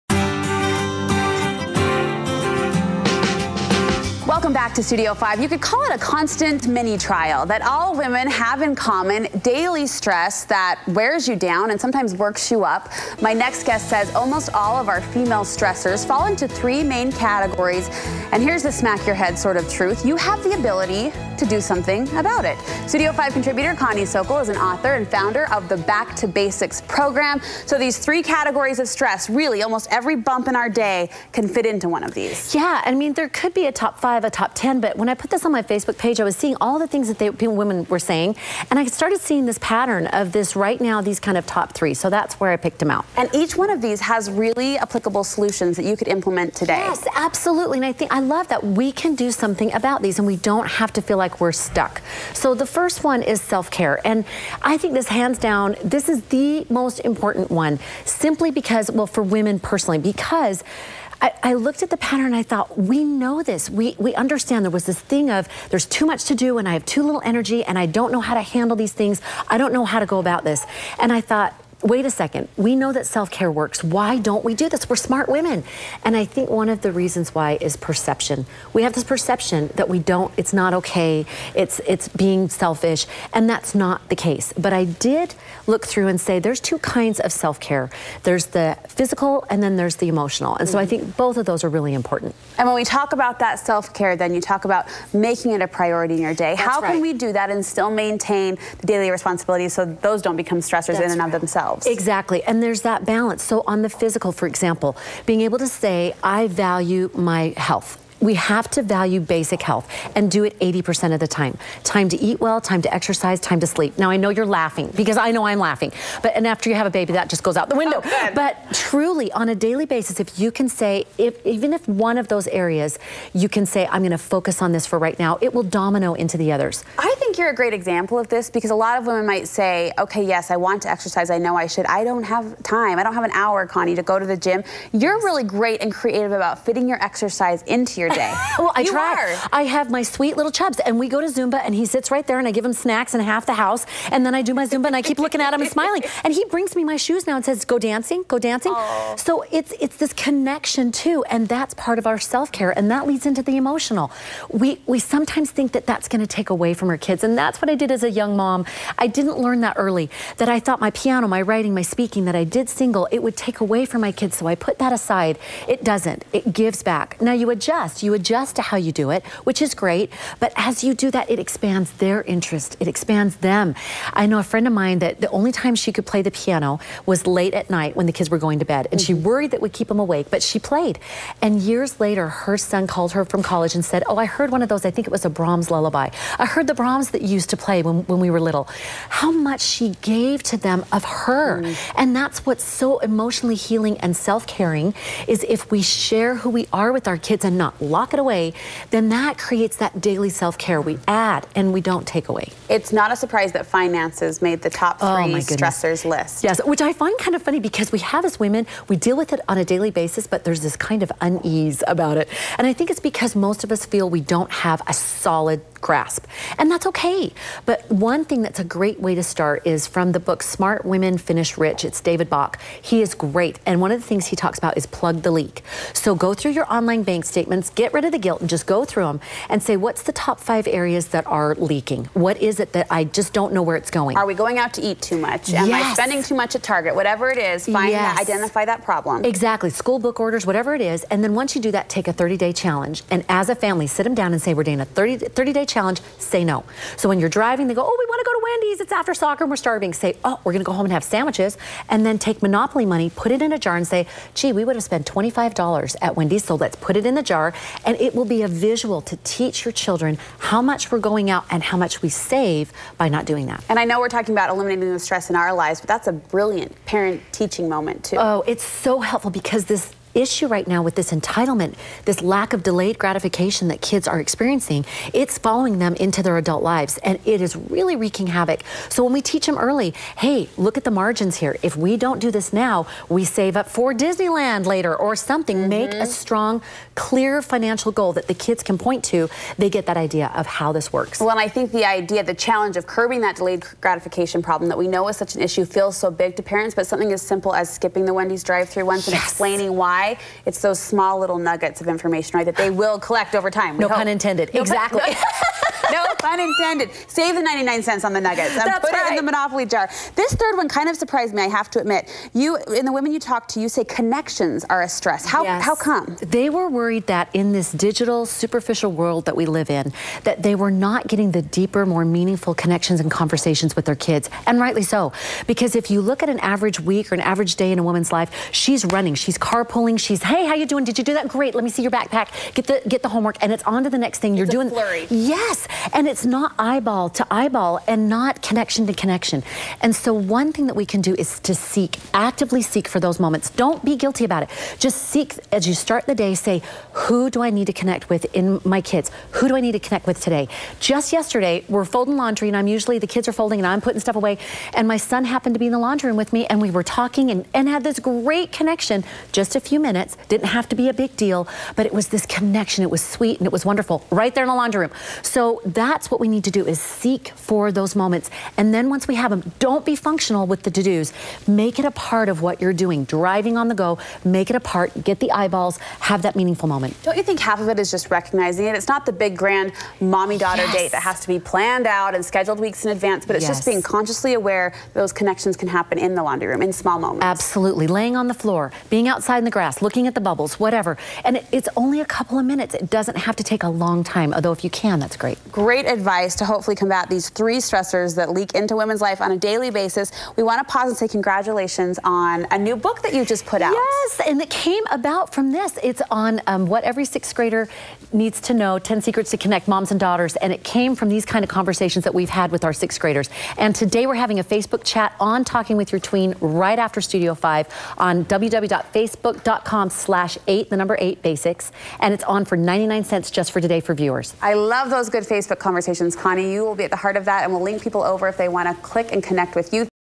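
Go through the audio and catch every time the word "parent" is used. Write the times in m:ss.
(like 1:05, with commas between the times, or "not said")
4:26, 4:56.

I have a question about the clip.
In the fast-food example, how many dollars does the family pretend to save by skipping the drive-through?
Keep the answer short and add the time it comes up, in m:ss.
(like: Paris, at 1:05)
$25, at 4:15.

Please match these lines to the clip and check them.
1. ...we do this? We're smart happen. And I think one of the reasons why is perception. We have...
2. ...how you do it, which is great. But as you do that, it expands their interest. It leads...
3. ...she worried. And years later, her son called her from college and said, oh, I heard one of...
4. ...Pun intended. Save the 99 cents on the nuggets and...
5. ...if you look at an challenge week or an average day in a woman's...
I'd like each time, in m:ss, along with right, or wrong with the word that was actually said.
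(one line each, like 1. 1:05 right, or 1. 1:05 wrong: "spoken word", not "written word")
1. 1:14 wrong: "women", not "happen"
2. 2:48 wrong: "expands", not "leads"
3. 3:00 wrong: "played", not "worried"
4. 5:06 right
5. 5:25 wrong: "average", not "challenge".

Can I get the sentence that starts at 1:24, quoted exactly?
But I did look through and say there's two kinds of self-care.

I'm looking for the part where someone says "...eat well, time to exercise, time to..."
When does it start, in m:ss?
1:52.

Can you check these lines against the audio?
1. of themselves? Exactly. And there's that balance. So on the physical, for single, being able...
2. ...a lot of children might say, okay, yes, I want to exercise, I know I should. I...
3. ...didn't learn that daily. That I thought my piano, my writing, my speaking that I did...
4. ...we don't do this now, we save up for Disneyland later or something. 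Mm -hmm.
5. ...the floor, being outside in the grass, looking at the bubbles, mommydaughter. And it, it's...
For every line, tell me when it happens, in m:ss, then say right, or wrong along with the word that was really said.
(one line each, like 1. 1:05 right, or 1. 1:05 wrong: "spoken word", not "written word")
1. 1:41 wrong: "example", not "single"
2. 2:08 wrong: "women", not "children"
3. 2:39 wrong: "early", not "daily"
4. 4:41 right
5. 6:28 wrong: "whatever", not "mommydaughter".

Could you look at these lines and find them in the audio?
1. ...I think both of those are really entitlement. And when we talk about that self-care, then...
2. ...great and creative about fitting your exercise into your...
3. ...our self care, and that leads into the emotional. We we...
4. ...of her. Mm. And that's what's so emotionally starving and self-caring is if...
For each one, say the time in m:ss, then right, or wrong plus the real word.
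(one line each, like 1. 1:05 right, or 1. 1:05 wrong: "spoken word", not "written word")
1. 1:30 wrong: "important", not "entitlement"
2. 2:15 right
3. 2:32 right
4. 3:10 wrong: "healing", not "starving".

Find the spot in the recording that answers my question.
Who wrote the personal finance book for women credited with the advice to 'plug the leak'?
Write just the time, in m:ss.
3:41.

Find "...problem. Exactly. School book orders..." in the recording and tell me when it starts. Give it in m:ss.
3:58.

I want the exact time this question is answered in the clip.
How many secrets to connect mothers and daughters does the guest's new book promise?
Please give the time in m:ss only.
6:48.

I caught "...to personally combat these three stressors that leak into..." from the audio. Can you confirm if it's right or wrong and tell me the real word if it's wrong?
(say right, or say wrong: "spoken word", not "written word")
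wrong: "hopefully", not "personally".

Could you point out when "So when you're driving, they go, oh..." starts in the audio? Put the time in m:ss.
4:06.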